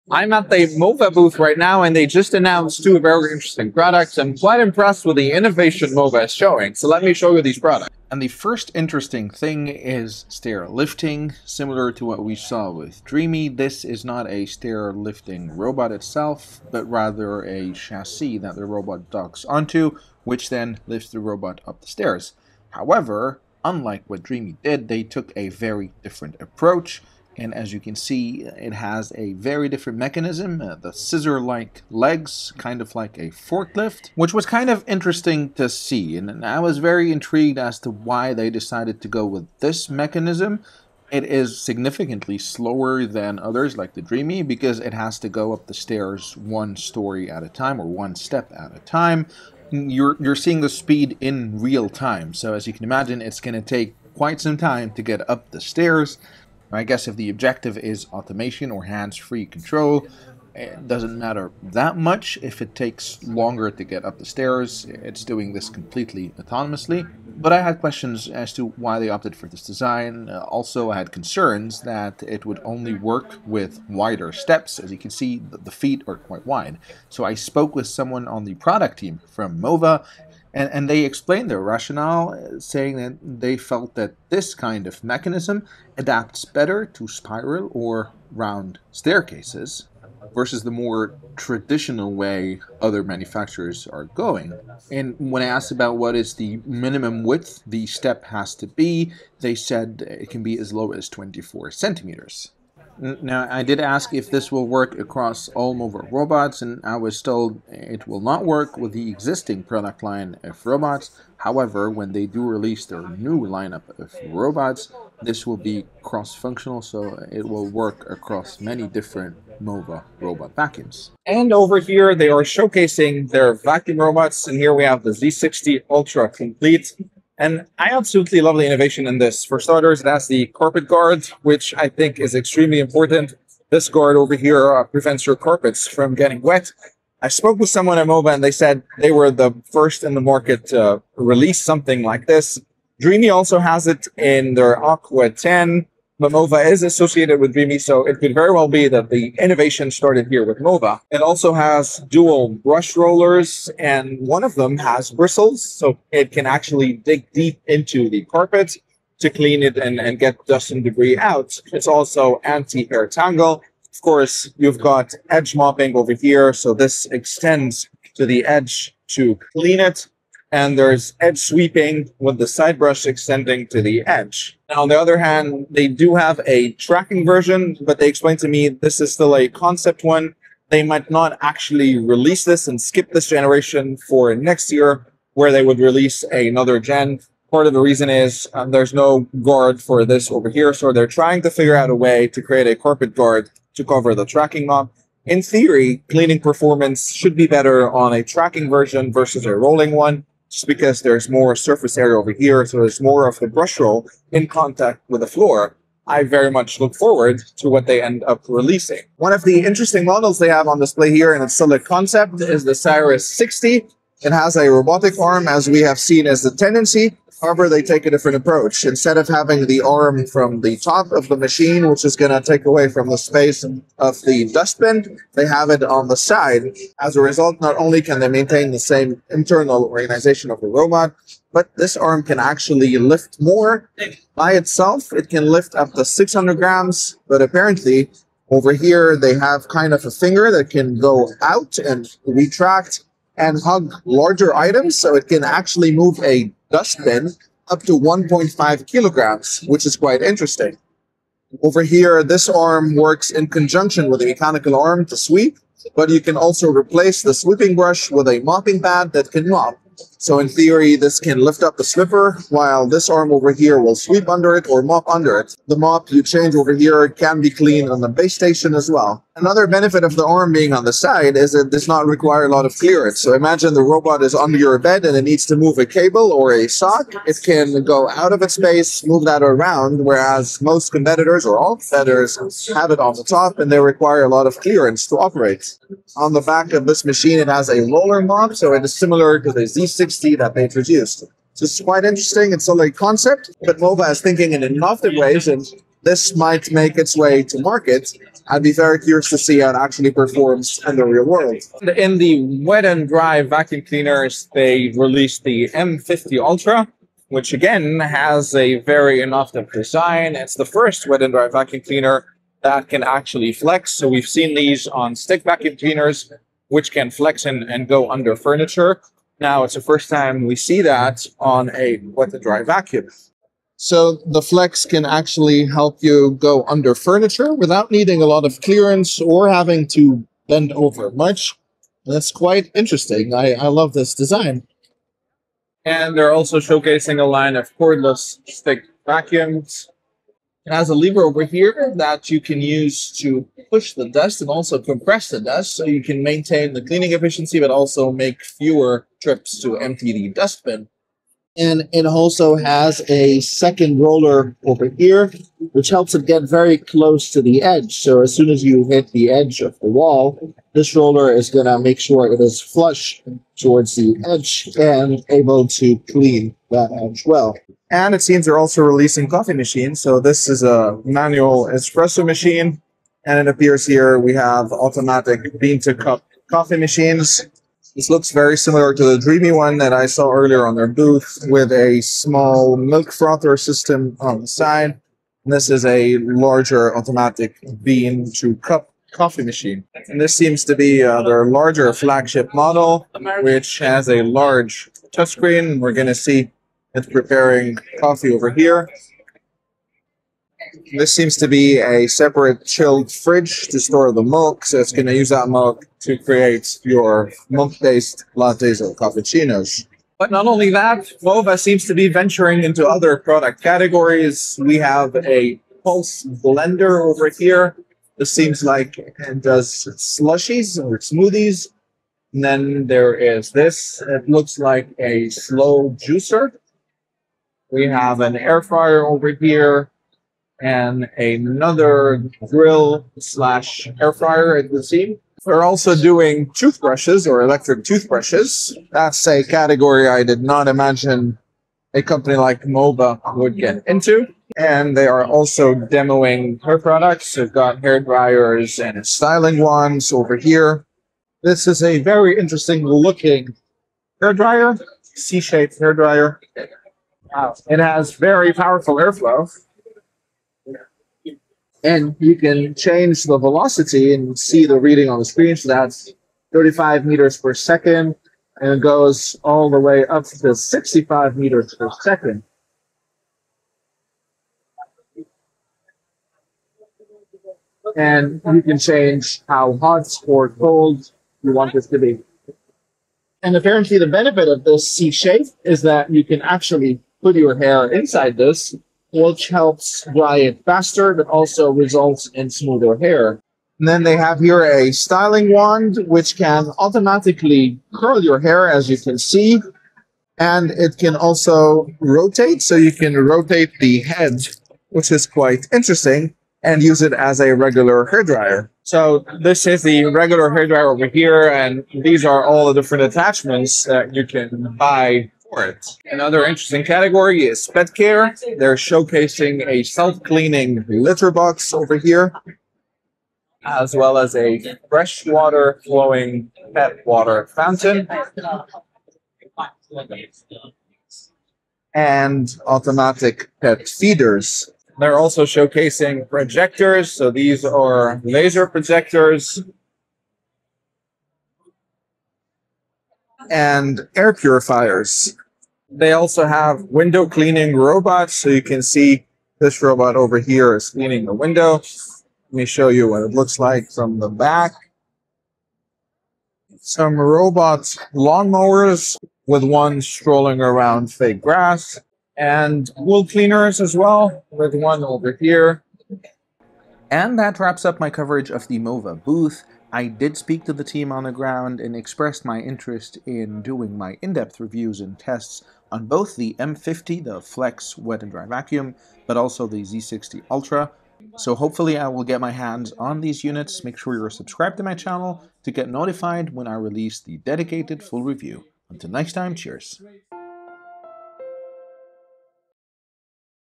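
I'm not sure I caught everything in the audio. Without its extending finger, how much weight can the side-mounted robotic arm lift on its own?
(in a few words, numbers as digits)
600 grams.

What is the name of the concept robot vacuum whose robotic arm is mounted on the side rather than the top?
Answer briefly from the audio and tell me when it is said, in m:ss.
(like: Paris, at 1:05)
Cyrus 60, at 3:32.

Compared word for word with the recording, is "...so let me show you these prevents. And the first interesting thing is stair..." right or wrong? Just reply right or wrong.
wrong.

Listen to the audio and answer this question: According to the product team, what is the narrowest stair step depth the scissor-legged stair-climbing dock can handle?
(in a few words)
24 centimeters.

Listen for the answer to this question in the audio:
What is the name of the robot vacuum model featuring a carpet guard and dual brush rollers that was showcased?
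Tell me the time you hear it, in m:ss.
2:05.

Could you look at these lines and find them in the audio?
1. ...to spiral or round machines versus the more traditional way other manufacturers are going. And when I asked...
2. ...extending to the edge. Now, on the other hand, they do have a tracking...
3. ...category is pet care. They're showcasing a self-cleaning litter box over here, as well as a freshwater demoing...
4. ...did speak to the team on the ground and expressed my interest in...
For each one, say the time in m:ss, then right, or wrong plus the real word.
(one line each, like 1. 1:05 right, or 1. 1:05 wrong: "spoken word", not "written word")
1. 1:26 wrong: "staircases", not "machines"
2. 2:53 right
3. 8:36 wrong: "flowing", not "demoing"
4. 9:30 right.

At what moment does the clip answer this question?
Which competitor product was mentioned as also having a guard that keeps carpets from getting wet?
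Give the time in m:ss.
2:24.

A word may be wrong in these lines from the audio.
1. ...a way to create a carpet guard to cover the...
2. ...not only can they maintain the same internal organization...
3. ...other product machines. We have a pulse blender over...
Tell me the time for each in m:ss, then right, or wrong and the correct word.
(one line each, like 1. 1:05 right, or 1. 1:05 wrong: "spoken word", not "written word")
1. 3:11 right
2. 3:47 right
3. 6:52 wrong: "categories", not "machines".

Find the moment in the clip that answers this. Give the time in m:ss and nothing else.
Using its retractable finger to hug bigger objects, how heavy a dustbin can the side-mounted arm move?
4:07.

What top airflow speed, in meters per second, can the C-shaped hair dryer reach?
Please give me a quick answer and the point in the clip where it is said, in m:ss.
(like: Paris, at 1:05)
65 meters per second, at 7:50.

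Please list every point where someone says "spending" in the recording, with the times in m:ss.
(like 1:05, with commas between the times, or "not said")
not said.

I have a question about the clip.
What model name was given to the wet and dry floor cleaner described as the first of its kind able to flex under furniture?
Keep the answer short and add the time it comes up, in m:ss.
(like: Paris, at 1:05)
M50 Ultra, at 5:05.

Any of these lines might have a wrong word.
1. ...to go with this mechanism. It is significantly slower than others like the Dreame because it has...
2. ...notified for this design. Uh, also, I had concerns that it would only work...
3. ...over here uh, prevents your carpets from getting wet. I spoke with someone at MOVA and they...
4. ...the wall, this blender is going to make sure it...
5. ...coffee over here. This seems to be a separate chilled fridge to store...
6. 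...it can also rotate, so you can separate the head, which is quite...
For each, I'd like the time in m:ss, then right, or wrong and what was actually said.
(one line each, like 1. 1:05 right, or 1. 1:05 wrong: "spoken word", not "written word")
1. 0:39 right
2. 1:09 wrong: "opted", not "notified"
3. 2:14 right
4. 5:59 wrong: "roller", not "blender"
5. 6:38 right
6. 8:20 wrong: "rotate", not "separate".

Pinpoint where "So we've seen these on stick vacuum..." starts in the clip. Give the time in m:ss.
5:13.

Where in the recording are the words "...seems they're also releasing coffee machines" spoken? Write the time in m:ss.
6:08.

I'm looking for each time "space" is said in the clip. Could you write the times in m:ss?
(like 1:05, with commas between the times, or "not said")
3:43, 4:38.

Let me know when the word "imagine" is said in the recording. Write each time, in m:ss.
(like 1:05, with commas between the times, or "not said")
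0:52, 4:33, 7:20.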